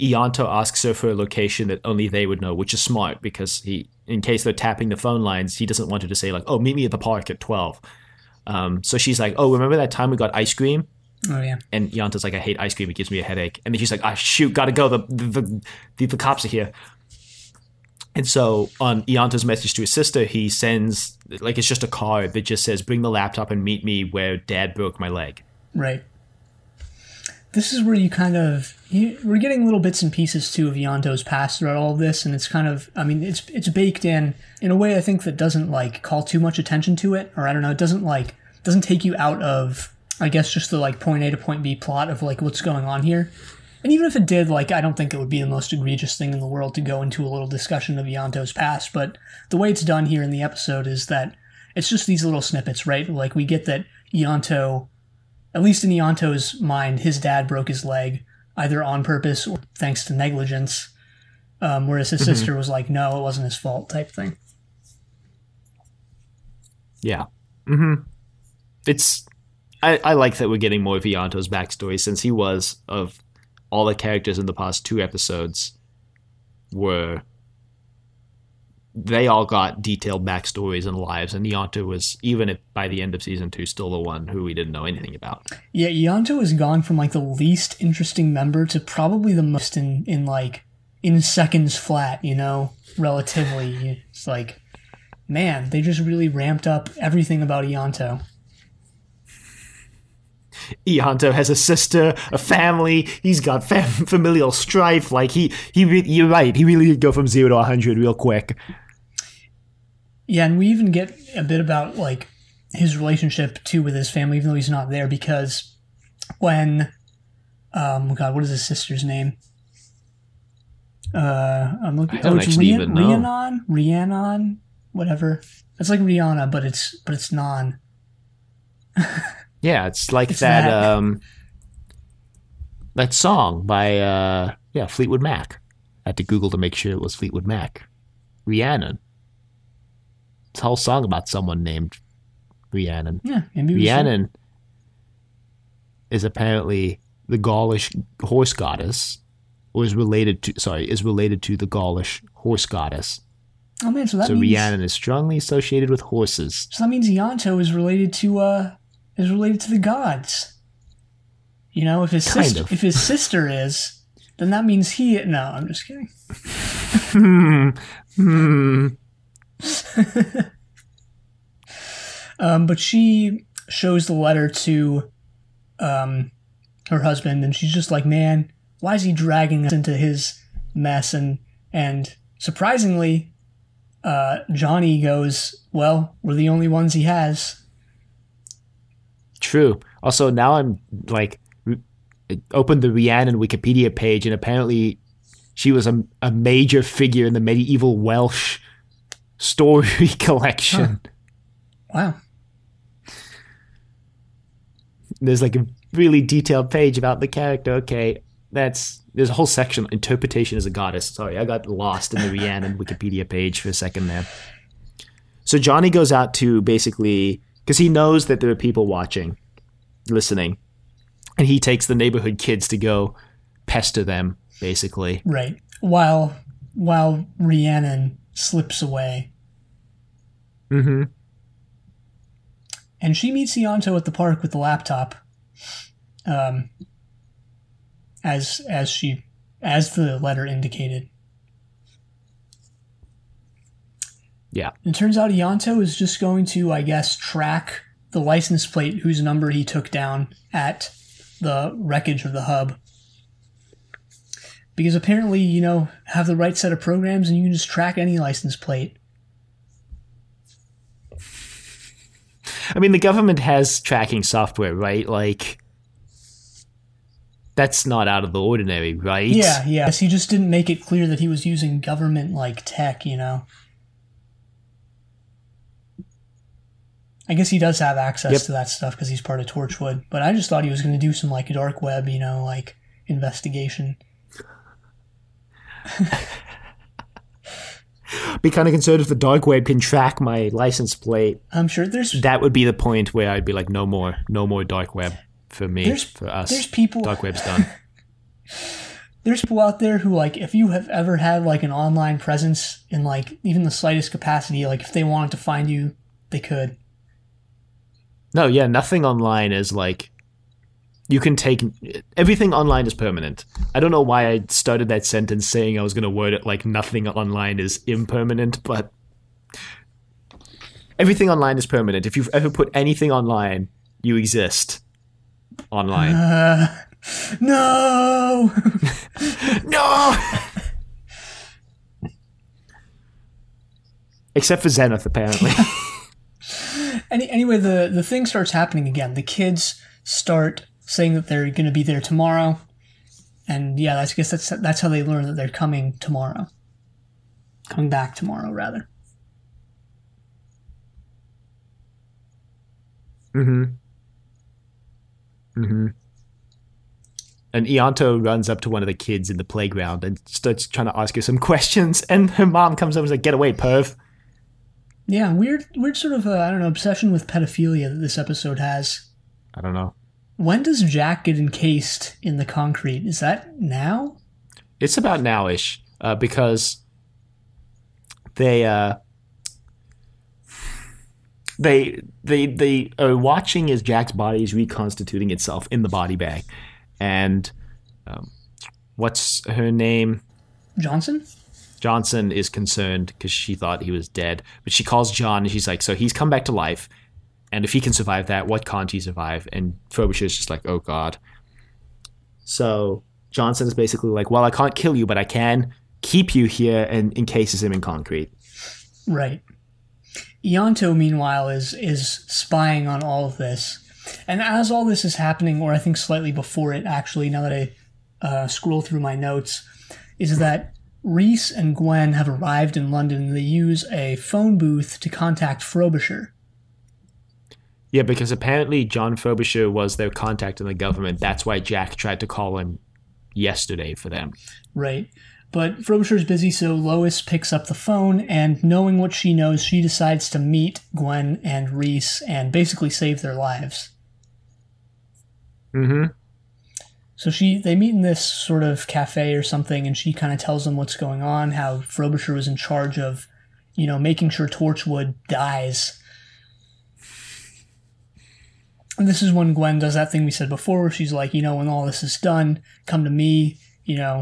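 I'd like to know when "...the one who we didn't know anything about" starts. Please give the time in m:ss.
1:23.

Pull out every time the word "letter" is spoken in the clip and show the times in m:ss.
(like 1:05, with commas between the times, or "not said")
2:54, 4:00.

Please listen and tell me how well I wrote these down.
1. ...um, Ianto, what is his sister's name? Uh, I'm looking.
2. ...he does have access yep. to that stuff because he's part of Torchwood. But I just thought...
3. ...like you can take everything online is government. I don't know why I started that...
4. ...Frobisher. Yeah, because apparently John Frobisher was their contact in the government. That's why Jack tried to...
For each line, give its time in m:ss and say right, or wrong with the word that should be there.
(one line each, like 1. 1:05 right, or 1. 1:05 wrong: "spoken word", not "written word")
1. 1:57 wrong: "God", not "Ianto"
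2. 4:37 right
3. 5:09 wrong: "permanent", not "government"
4. 7:05 right.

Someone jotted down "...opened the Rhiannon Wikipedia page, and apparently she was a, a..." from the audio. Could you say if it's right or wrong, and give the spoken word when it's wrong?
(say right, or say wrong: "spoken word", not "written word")
right.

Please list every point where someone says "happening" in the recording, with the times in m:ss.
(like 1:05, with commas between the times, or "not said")
5:38, 6:55.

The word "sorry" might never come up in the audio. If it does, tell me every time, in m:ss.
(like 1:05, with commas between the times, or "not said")
2:30, 3:31.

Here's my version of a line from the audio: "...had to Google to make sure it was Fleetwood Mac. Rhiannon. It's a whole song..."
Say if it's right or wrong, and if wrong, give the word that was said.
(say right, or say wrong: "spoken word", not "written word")
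right.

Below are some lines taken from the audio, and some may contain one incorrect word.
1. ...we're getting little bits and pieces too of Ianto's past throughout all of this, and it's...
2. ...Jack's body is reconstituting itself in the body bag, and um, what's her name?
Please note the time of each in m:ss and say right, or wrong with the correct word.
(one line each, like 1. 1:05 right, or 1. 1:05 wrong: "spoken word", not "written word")
1. 0:29 right
2. 6:23 right.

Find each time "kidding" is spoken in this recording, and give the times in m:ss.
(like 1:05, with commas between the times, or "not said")
2:45.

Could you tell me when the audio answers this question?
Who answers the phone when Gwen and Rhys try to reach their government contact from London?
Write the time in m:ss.
7:16.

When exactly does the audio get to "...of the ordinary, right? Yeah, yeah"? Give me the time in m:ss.
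4:28.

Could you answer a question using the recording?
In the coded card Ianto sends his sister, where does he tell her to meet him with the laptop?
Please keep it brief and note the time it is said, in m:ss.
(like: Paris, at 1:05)
Where Dad broke my leg, at 0:24.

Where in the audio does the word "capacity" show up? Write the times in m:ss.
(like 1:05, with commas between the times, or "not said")
5:04.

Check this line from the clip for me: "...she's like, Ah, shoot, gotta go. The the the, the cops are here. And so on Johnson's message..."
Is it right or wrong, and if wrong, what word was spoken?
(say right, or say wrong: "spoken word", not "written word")
wrong: "Ianto", not "Johnson".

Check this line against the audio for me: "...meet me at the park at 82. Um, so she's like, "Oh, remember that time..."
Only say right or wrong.
wrong.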